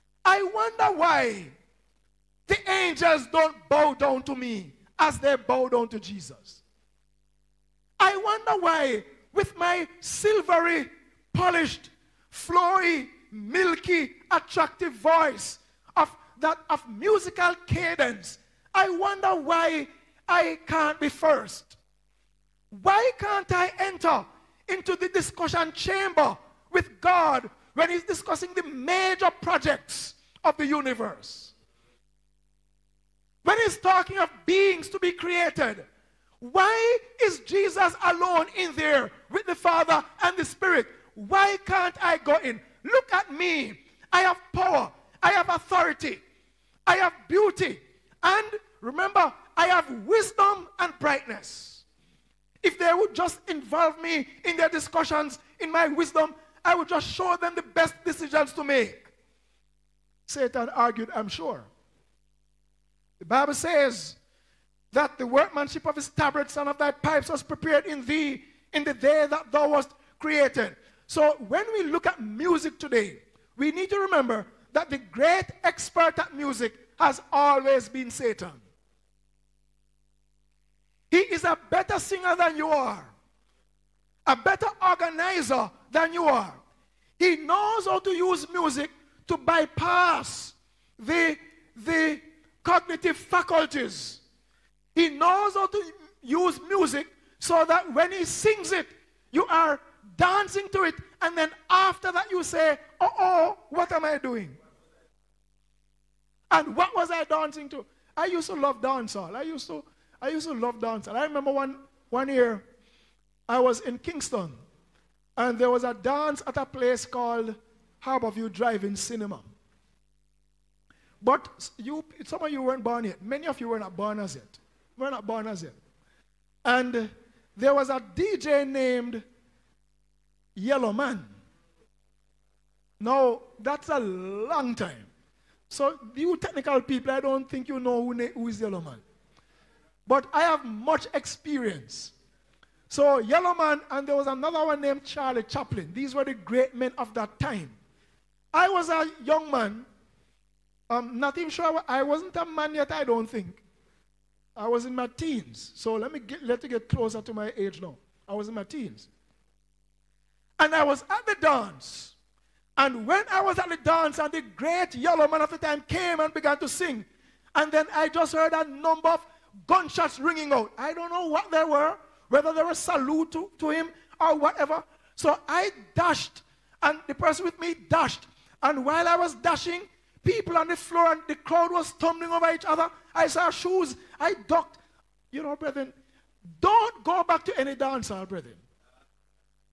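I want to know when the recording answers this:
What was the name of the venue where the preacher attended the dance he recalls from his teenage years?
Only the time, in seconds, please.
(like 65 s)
118 s.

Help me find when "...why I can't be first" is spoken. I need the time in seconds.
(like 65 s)
19 s.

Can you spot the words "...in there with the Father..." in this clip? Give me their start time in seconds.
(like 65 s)
38 s.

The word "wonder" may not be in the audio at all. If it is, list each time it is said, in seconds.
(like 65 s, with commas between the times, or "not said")
0 s, 8 s, 18 s.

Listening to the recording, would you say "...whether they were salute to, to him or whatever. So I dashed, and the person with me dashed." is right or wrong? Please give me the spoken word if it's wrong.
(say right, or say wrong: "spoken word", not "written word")
right.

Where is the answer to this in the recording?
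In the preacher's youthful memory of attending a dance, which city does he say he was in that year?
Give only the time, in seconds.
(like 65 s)
113 s.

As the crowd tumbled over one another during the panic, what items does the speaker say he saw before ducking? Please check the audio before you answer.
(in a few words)
shoes.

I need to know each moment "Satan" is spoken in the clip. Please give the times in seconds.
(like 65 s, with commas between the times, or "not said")
60 s, 78 s.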